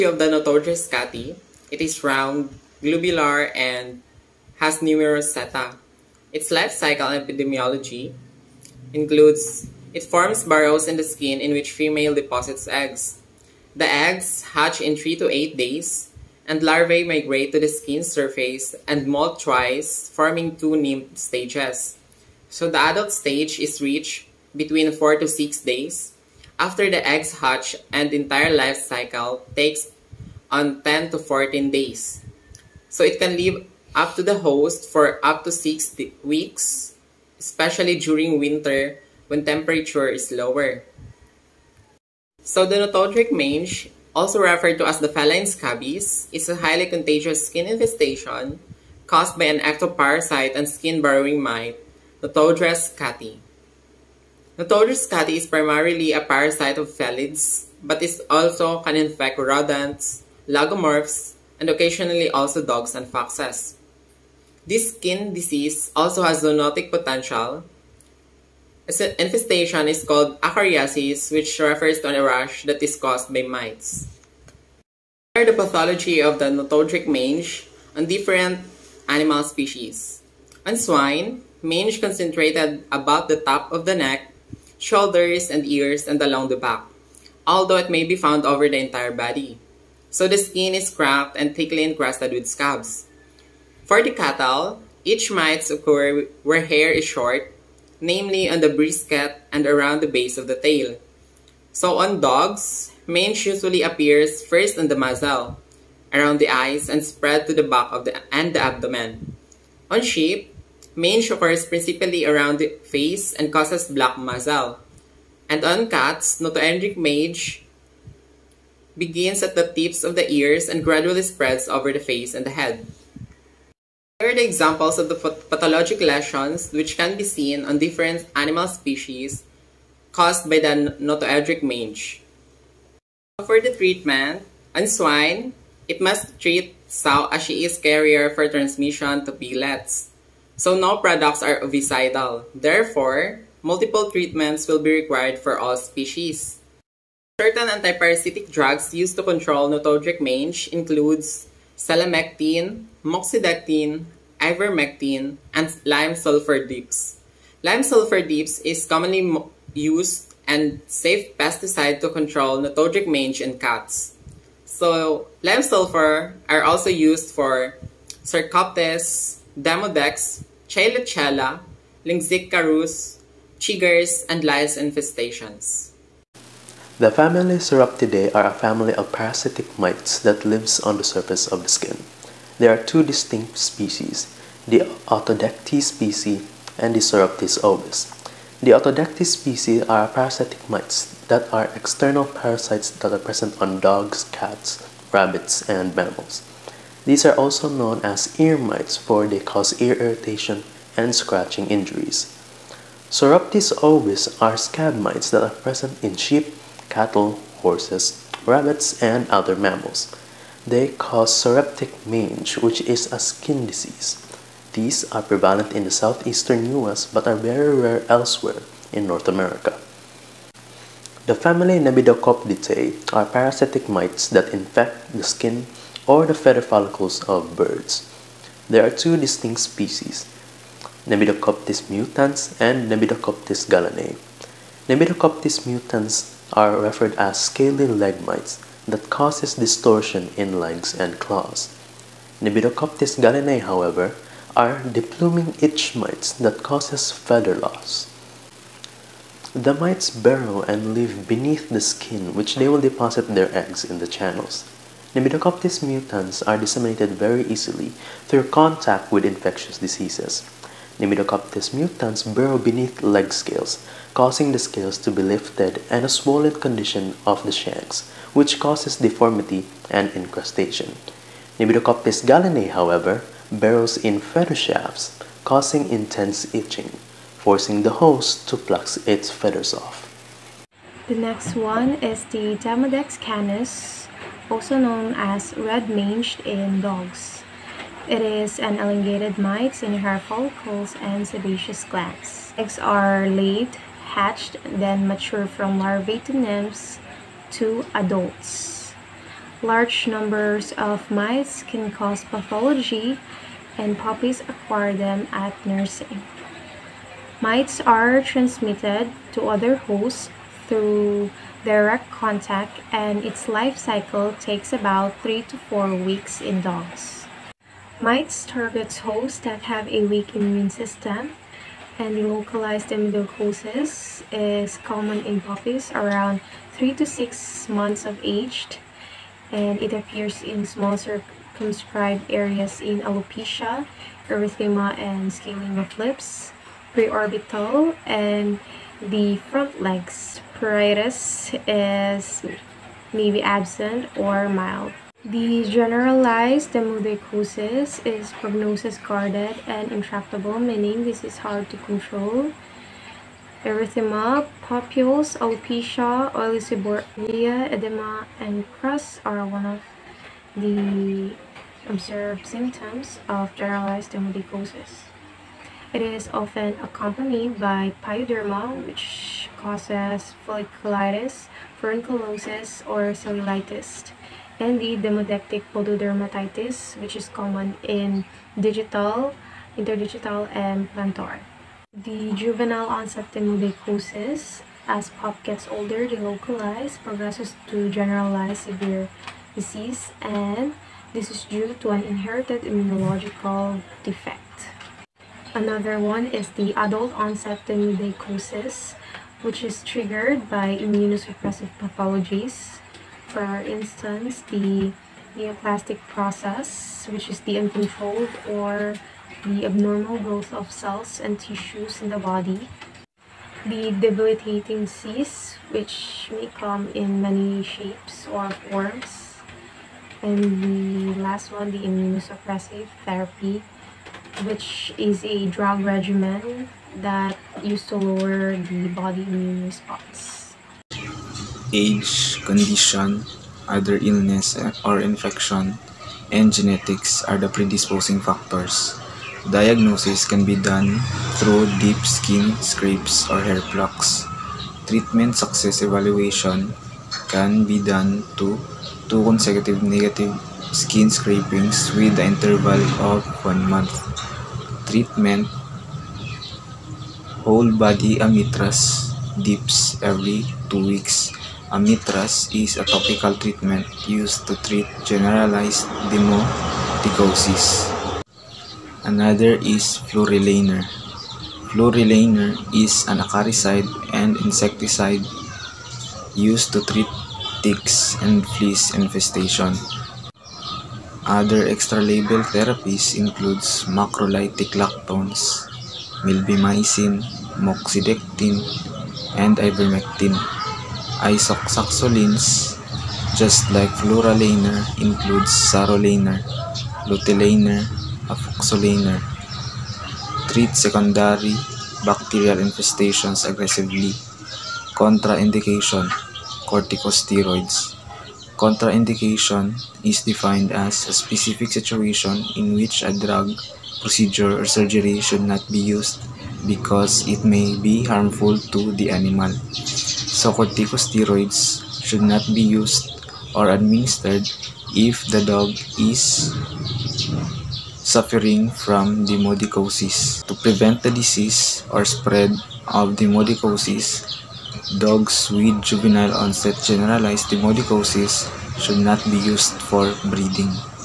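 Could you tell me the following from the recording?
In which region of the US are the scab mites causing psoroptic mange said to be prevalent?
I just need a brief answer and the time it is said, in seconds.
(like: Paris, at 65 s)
southeastern US, at 215 s.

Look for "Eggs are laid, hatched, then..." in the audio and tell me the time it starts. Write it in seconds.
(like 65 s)
292 s.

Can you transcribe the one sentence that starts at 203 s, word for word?
Psoroptes ovis are scab mites that are present in sheep, cattle, horses, rabbits, and other mammals.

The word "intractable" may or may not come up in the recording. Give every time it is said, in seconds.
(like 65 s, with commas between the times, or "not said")
349 s.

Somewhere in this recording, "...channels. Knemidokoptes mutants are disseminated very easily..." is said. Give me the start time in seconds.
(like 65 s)
254 s.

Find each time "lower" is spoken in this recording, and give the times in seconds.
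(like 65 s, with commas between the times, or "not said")
40 s, 427 s.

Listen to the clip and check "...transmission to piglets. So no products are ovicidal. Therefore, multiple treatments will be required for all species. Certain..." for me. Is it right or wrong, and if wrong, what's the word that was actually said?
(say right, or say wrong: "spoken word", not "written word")
right.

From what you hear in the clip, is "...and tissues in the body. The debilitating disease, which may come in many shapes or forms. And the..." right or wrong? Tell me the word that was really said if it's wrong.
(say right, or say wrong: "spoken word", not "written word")
right.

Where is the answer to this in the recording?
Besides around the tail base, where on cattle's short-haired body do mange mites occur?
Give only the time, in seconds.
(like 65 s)
98 s.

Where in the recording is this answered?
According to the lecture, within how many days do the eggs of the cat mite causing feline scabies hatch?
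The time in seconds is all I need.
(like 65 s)
14 s.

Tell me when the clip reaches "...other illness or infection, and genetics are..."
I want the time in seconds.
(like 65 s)
433 s.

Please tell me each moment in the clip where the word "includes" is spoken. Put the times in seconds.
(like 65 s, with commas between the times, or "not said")
8 s, 150 s, 483 s, 495 s.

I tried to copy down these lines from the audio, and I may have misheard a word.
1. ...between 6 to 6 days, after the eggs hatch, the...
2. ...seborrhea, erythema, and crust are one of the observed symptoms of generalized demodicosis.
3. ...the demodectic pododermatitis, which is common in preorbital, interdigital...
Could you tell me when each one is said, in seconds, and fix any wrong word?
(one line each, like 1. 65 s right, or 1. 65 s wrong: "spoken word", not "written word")
1. 24 s wrong: "4", not "6"
2. 356 s wrong: "edema", not "erythema"
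3. 374 s wrong: "digital", not "preorbital".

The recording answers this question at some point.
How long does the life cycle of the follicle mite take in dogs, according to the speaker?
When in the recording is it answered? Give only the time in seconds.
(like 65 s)
315 s.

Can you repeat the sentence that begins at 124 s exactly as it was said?
Here are the examples of the pathologic lesions which can be seen on different animal species caused by the notoedric mange.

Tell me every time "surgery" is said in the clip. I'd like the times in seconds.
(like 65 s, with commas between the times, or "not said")
514 s.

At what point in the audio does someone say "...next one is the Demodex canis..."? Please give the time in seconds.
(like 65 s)
281 s.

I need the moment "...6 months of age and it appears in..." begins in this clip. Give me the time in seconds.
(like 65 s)
327 s.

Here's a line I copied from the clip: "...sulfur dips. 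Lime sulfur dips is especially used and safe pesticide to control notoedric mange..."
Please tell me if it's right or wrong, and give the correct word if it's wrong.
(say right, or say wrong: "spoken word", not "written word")
wrong: "commonly", not "especially".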